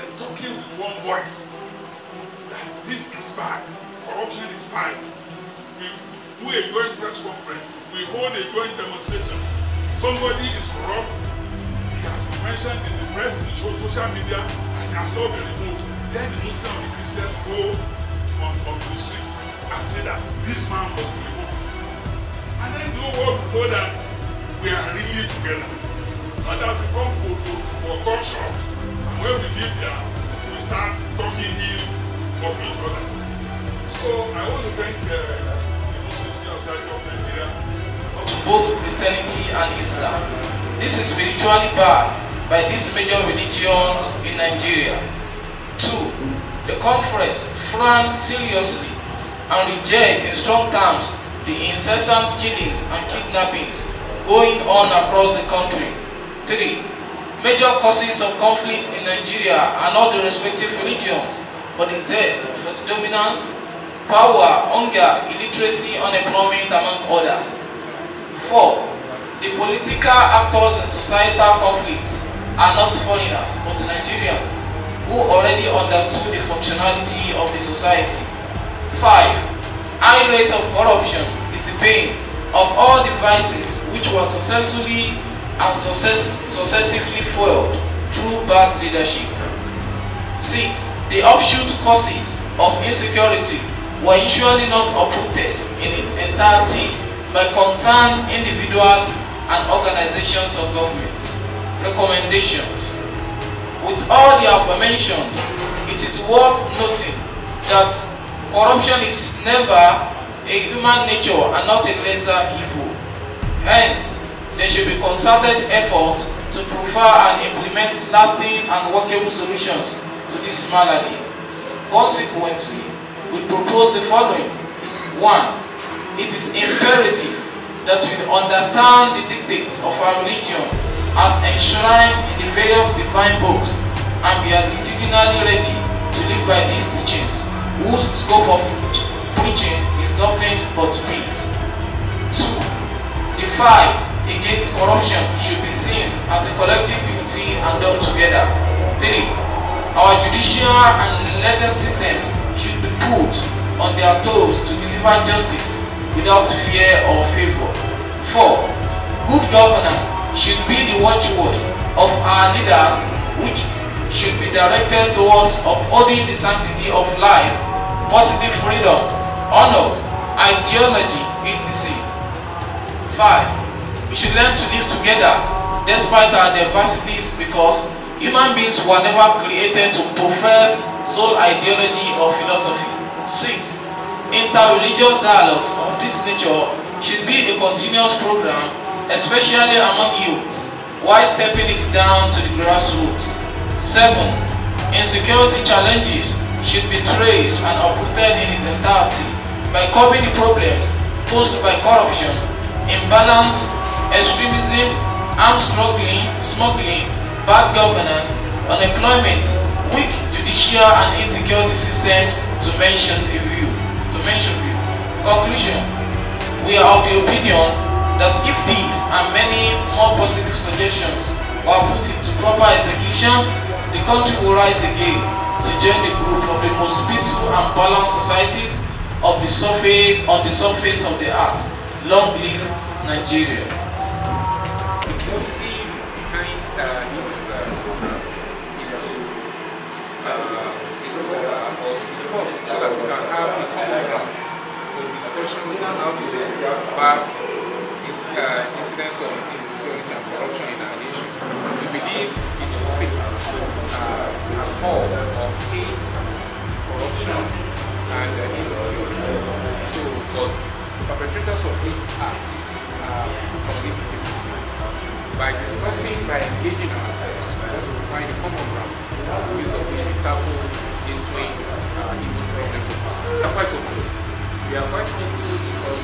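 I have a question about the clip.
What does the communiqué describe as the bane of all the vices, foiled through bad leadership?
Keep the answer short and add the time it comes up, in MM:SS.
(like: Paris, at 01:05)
High rate of corruption, at 01:20.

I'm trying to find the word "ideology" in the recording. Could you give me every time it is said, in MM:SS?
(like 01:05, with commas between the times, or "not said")
02:50, 03:01.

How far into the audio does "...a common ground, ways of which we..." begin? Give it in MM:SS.
04:28.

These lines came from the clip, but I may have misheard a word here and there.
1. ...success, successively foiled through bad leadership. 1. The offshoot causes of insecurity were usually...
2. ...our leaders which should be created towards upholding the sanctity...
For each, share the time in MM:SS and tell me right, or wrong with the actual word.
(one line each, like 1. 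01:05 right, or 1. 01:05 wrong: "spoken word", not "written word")
1. 01:25 wrong: "6", not "1"
2. 02:42 wrong: "directed", not "created".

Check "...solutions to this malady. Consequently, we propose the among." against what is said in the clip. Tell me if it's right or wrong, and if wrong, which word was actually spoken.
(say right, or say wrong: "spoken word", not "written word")
wrong: "following", not "among".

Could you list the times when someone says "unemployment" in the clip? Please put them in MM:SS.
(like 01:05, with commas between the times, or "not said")
01:05, 03:28.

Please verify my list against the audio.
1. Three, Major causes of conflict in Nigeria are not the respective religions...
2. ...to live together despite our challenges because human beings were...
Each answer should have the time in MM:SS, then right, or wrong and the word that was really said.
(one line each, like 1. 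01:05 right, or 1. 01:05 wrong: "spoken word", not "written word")
1. 00:56 right
2. 02:54 wrong: "diversities", not "challenges".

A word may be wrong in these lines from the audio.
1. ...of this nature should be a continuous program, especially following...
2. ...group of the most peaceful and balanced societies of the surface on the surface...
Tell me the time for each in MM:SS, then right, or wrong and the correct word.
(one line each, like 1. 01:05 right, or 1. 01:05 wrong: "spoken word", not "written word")
1. 03:05 wrong: "among", not "following"
2. 03:46 right.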